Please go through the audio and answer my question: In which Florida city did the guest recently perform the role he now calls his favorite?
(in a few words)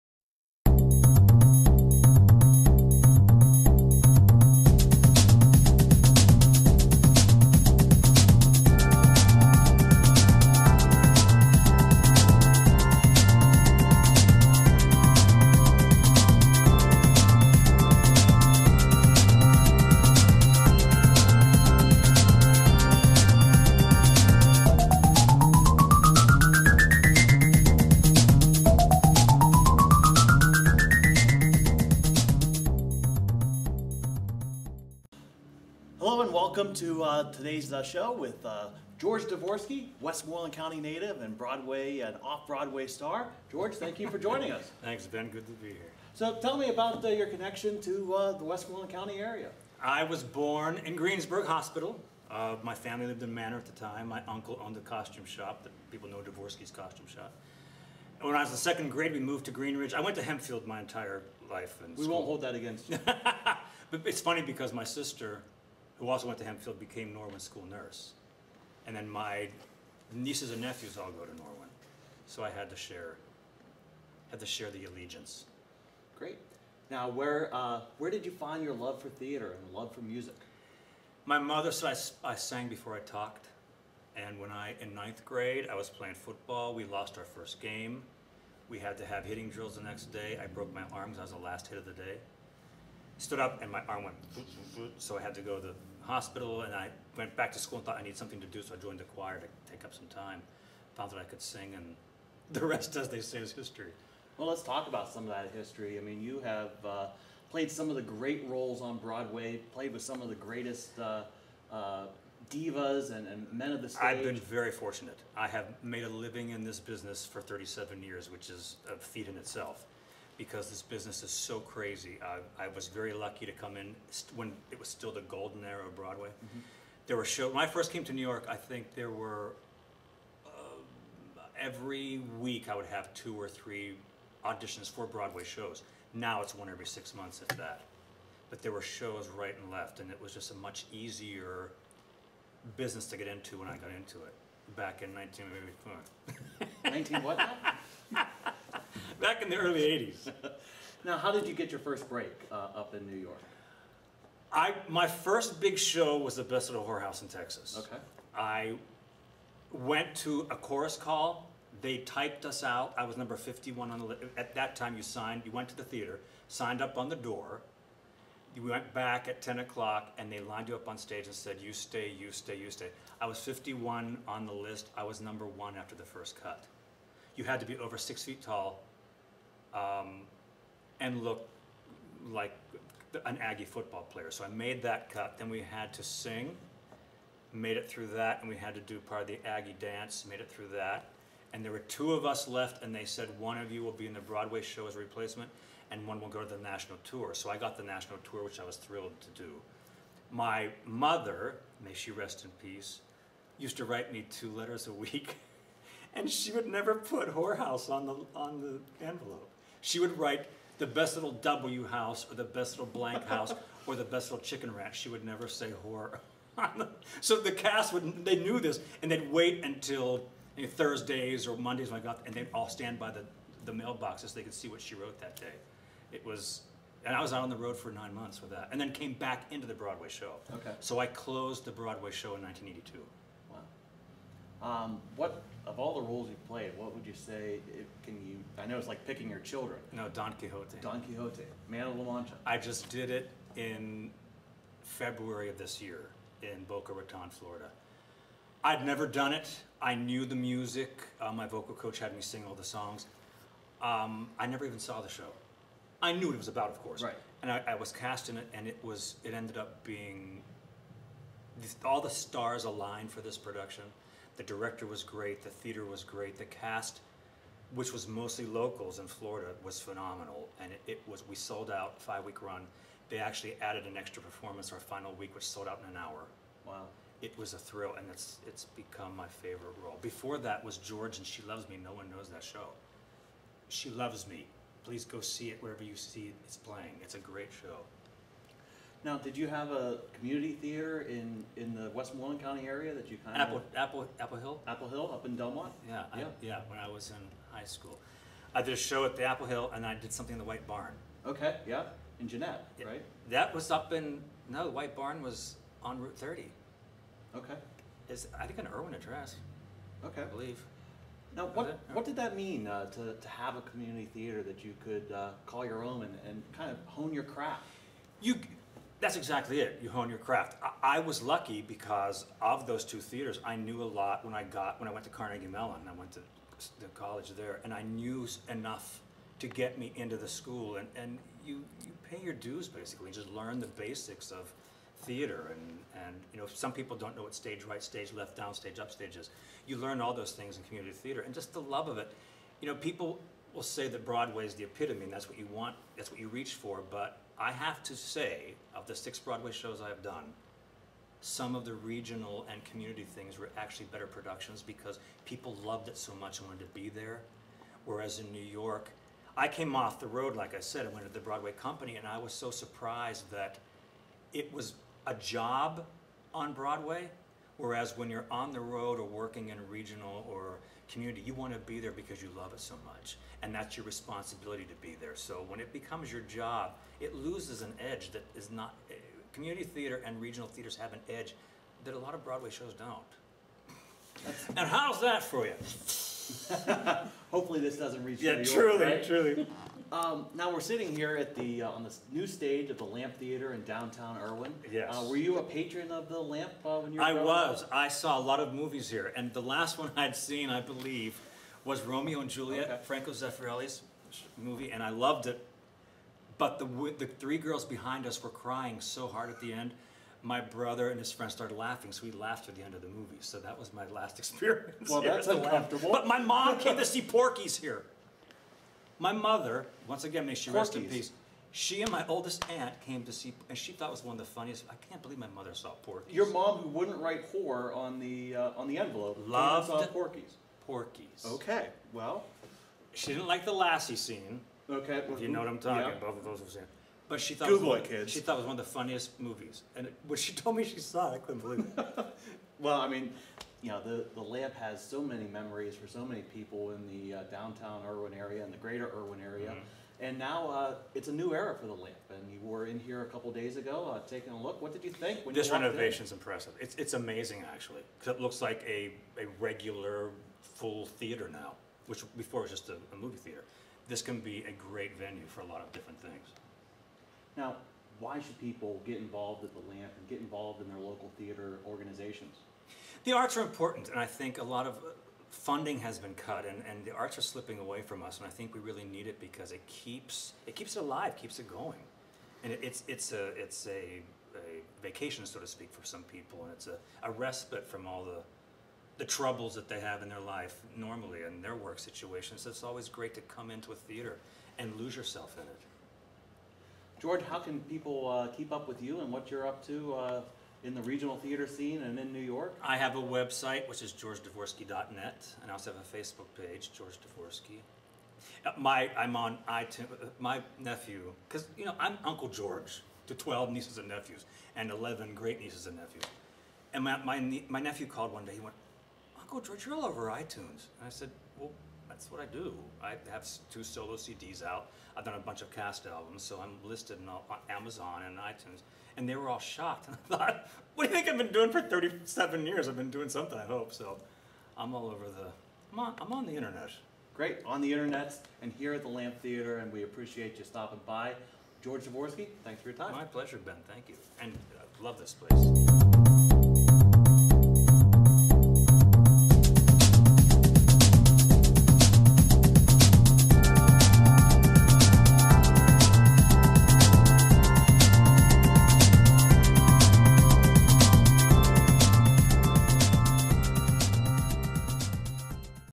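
Boca Raton.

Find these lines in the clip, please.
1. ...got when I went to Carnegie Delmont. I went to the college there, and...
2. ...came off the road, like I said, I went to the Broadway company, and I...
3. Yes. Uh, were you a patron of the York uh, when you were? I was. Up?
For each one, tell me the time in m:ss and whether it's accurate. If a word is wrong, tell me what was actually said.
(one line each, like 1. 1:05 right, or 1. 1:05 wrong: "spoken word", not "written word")
1. 5:24 wrong: "Mellon", not "Delmont"
2. 5:59 right
3. 6:34 wrong: "Lamp", not "York".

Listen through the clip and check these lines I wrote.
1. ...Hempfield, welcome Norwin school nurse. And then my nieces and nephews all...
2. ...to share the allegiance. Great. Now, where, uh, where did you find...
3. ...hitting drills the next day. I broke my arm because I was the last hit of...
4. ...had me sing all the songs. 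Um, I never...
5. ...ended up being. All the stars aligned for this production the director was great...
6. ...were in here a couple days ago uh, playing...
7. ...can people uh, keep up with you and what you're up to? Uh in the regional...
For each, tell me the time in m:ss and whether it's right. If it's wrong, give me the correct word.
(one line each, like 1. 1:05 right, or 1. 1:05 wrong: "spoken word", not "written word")
1. 1:06 wrong: "became", not "welcome"
2. 1:14 right
3. 1:29 right
4. 4:11 right
5. 4:19 right
6. 7:32 wrong: "taking", not "playing"
7. 8:17 right.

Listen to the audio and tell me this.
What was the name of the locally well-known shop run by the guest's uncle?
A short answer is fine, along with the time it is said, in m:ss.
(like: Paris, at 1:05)
Dvorsky's costume shop, at 0:56.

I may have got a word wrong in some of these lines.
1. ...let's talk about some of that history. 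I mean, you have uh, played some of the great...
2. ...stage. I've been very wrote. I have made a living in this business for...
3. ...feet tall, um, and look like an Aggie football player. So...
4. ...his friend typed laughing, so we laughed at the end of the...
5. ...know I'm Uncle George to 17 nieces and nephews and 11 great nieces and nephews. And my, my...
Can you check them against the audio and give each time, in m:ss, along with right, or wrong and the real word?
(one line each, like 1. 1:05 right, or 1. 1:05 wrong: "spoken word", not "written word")
1. 1:44 right
2. 1:53 wrong: "fortunate", not "wrote"
3. 2:58 right
4. 6:50 wrong: "started", not "typed"
5. 8:31 wrong: "12", not "17".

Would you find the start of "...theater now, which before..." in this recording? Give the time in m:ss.
7:40.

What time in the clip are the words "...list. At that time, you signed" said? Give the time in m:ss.
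2:44.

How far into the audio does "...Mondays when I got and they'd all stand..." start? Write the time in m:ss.
3:41.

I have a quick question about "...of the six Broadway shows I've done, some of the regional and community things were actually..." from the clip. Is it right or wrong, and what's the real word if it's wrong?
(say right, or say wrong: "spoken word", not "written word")
right.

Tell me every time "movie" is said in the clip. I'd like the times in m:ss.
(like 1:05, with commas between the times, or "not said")
6:38, 6:44, 6:52, 7:19, 7:42.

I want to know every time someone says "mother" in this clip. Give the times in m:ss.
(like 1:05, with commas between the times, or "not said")
1:21, 3:20, 6:59, 7:05.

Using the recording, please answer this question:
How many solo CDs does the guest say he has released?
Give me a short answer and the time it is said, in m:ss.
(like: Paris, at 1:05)
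2, at 8:43.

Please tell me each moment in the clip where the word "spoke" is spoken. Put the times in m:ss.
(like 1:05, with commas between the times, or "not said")
not said.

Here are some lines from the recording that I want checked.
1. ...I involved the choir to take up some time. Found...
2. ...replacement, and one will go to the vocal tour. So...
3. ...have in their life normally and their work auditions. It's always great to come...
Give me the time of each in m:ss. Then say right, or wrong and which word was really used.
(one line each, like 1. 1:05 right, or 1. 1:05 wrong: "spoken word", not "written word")
1. 1:38 wrong: "joined", not "involved"
2. 3:14 wrong: "national", not "vocal"
3. 8:09 wrong: "situations", not "auditions".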